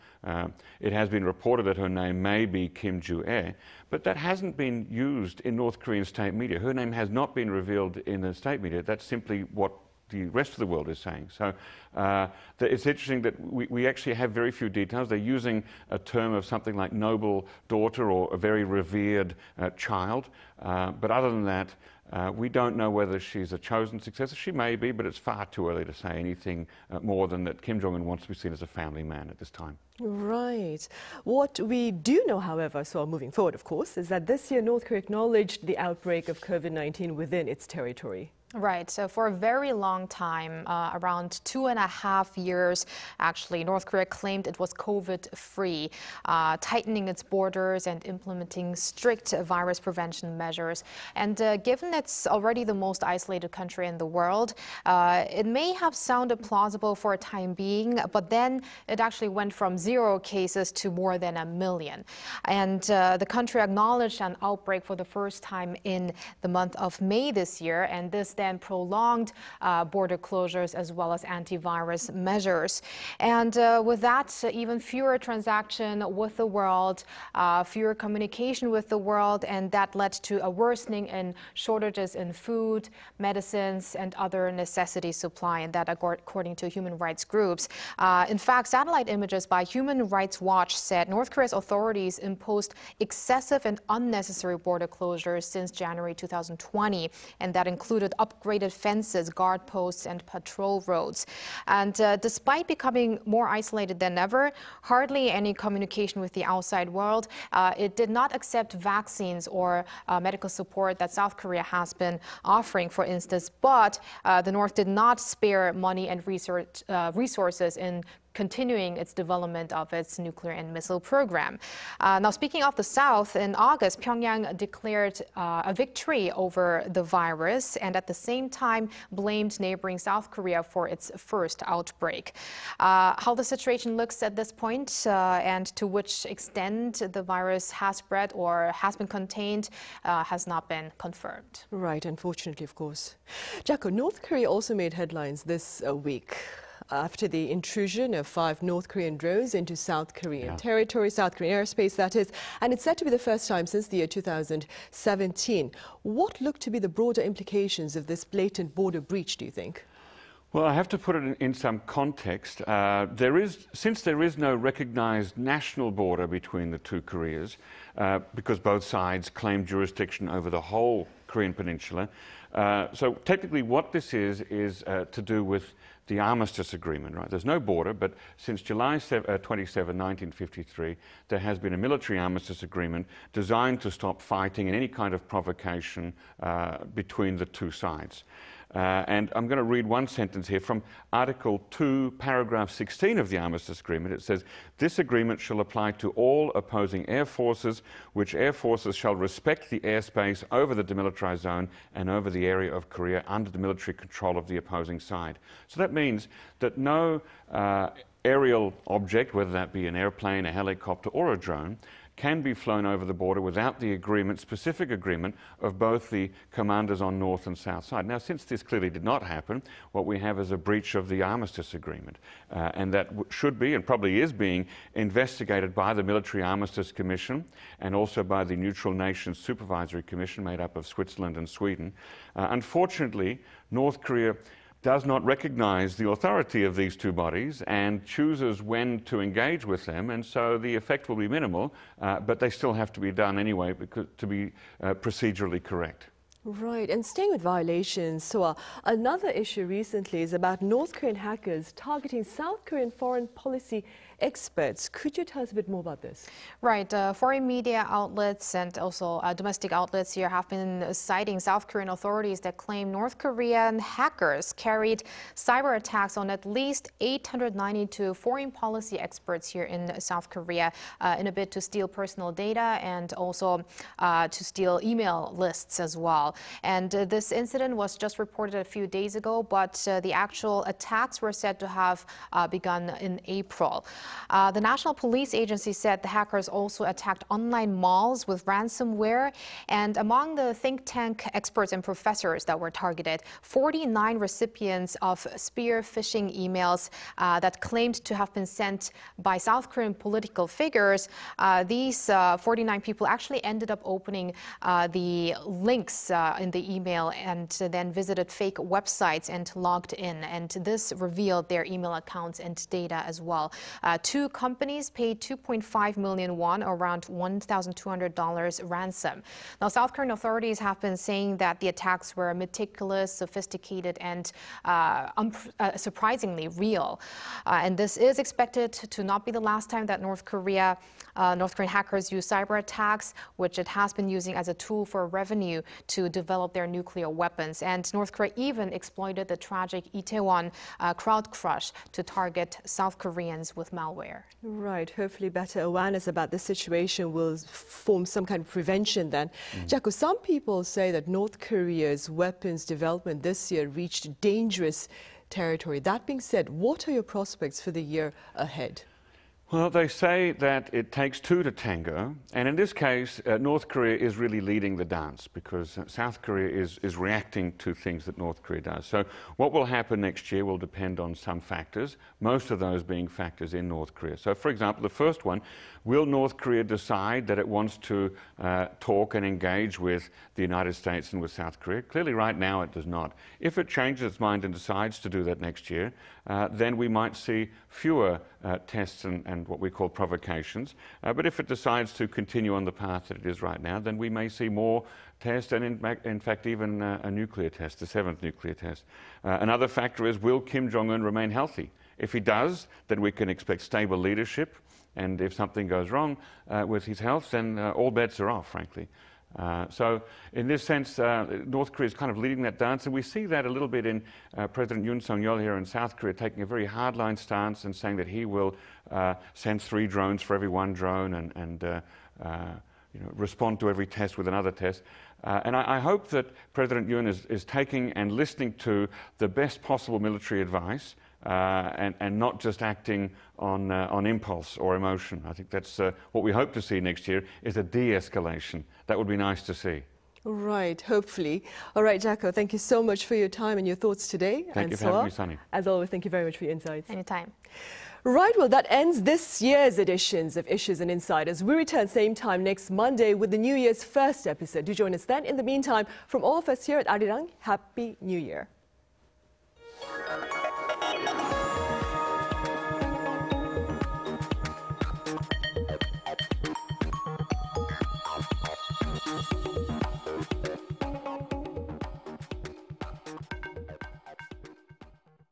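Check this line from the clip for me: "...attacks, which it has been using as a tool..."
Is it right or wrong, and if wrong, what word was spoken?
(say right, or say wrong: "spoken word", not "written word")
right.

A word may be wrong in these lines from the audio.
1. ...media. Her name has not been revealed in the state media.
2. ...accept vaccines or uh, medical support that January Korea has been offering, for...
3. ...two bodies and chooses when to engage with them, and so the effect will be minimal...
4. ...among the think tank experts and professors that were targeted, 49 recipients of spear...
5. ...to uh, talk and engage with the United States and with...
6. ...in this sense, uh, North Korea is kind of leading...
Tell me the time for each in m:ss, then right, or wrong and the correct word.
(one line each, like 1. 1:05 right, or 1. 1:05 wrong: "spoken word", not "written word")
1. 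0:06 right
2. 1:48 wrong: "South", not "January"
3. 3:56 right
4. 4:49 right
5. 6:17 right
6. 6:50 right.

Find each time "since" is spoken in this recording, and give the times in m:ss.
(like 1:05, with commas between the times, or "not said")
1:35, 2:33, 2:43, 2:58, 3:38.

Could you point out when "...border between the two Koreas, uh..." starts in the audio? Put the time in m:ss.
2:45.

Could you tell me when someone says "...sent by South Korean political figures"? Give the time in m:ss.
4:58.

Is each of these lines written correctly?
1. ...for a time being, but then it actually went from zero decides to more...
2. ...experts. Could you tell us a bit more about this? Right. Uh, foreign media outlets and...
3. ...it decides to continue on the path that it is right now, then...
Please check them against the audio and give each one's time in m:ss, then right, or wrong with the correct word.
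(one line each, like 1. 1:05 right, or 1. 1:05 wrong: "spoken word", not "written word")
1. 0:56 wrong: "cases", not "decides"
2. 4:14 right
3. 6:31 right.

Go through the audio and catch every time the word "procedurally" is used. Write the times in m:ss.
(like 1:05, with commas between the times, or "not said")
4:04.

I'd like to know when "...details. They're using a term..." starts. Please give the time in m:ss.
0:14.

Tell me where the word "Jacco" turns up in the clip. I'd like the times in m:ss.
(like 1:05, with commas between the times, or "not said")
2:23, 5:49, 7:22.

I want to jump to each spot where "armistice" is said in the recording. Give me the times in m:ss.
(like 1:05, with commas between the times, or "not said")
2:56, 3:02, 3:13, 3:41, 3:46.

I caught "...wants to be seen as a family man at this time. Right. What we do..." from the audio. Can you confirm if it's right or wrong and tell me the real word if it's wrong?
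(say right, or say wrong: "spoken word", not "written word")
right.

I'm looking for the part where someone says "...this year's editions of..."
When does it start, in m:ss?
7:29.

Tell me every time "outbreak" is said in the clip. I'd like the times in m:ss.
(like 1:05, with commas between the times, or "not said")
0:35, 1:04, 2:11.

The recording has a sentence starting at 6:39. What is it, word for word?
Uh, another factor is will Kim Jong un remain healthy?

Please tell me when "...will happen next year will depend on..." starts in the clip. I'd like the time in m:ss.
6:09.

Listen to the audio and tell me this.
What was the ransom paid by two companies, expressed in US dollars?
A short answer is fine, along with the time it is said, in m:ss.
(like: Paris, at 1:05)
$1,200, at 5:17.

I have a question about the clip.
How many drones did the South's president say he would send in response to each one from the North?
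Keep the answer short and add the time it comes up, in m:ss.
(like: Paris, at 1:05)
3, at 6:59.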